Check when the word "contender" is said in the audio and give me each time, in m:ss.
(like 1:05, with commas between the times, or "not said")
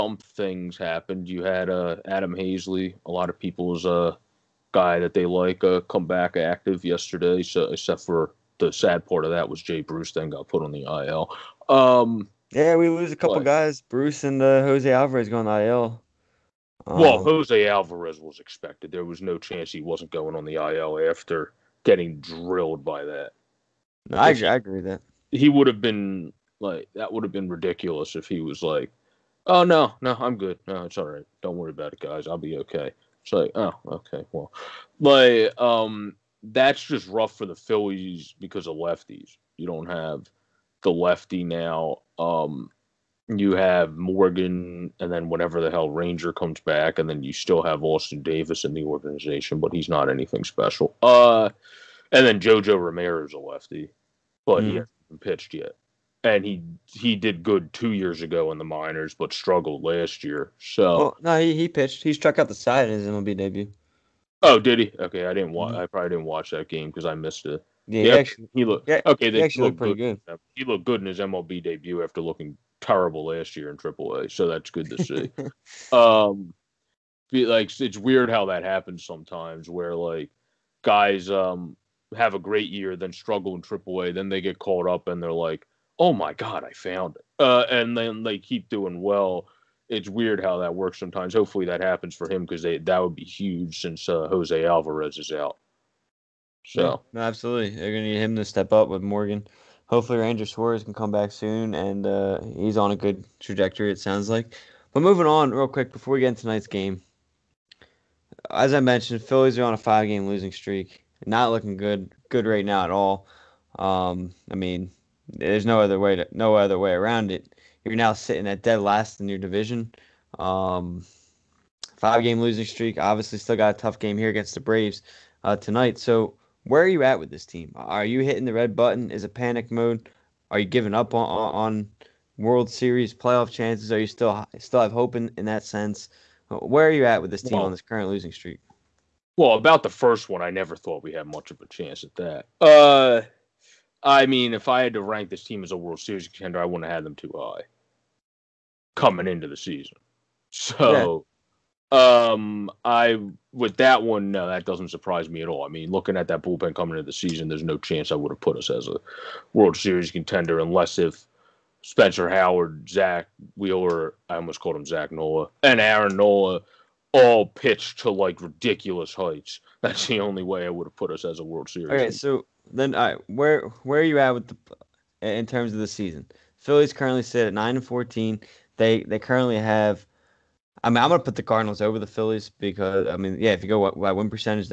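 2:26, 2:40.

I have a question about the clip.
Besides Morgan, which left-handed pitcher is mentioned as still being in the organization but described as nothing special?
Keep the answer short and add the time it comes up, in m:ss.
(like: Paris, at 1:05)
Austin Davis, at 0:47.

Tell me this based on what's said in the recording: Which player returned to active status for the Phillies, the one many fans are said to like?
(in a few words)
Adam Haseley.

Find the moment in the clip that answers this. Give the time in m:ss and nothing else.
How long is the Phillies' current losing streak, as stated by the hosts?
1:49.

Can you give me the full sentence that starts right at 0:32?
I'll be okay." It's like, oh, okay, well, like um, that's just rough for the Phillies because of lefties.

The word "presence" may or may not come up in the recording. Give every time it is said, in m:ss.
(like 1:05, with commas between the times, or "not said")
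not said.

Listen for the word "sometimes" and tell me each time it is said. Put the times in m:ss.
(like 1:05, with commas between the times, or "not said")
1:19, 1:30.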